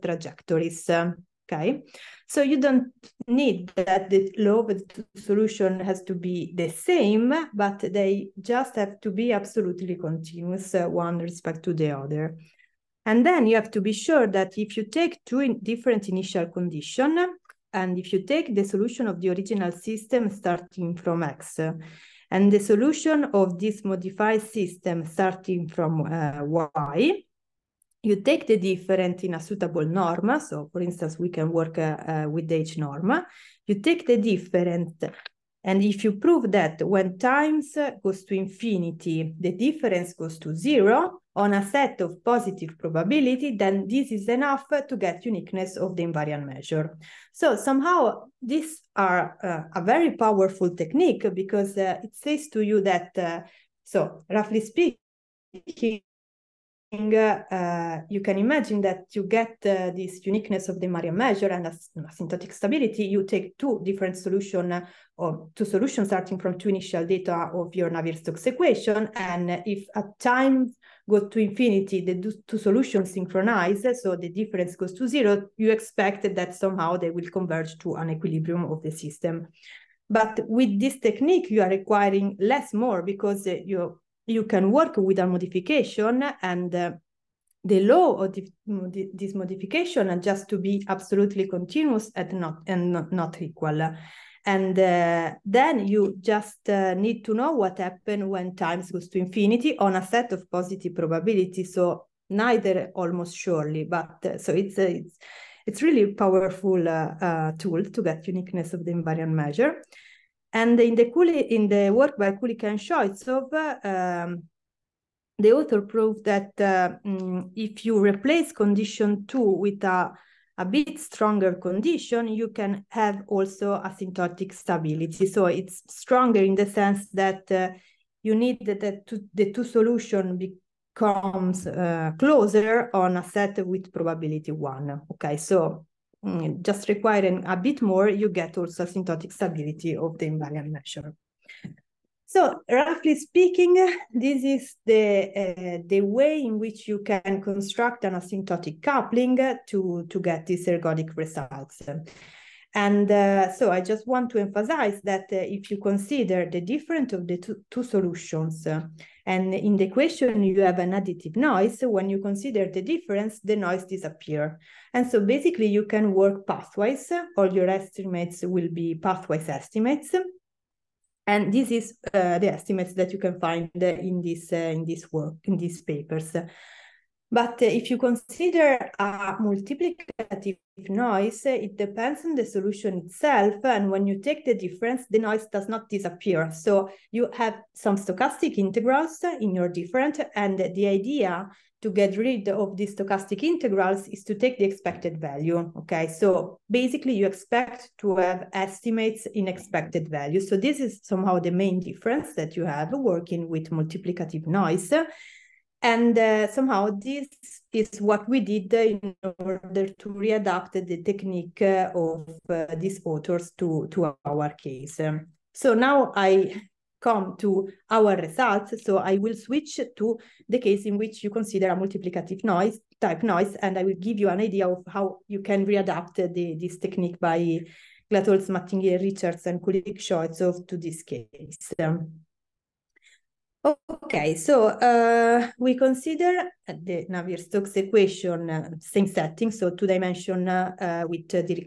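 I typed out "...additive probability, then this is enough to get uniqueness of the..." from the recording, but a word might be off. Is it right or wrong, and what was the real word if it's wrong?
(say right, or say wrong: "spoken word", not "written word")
wrong: "positive", not "additive".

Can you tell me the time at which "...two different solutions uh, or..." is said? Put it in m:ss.
1:03.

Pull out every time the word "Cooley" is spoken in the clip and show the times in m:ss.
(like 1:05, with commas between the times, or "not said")
1:51.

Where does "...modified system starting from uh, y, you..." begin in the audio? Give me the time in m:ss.
0:23.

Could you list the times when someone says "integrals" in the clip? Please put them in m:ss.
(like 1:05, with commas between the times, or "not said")
3:08, 3:13.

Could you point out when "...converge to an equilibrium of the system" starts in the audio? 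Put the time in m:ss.
1:17.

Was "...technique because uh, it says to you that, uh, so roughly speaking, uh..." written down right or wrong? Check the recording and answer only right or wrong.
right.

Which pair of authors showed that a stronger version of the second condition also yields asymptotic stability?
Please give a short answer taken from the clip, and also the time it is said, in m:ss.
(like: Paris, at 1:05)
Kulik and Scheutzow, at 1:52.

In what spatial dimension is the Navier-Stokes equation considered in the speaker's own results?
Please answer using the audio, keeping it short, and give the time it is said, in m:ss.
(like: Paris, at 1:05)
2, at 3:59.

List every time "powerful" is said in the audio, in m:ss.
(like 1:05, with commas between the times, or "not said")
0:50, 1:46.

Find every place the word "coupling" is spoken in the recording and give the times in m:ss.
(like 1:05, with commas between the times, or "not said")
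2:28.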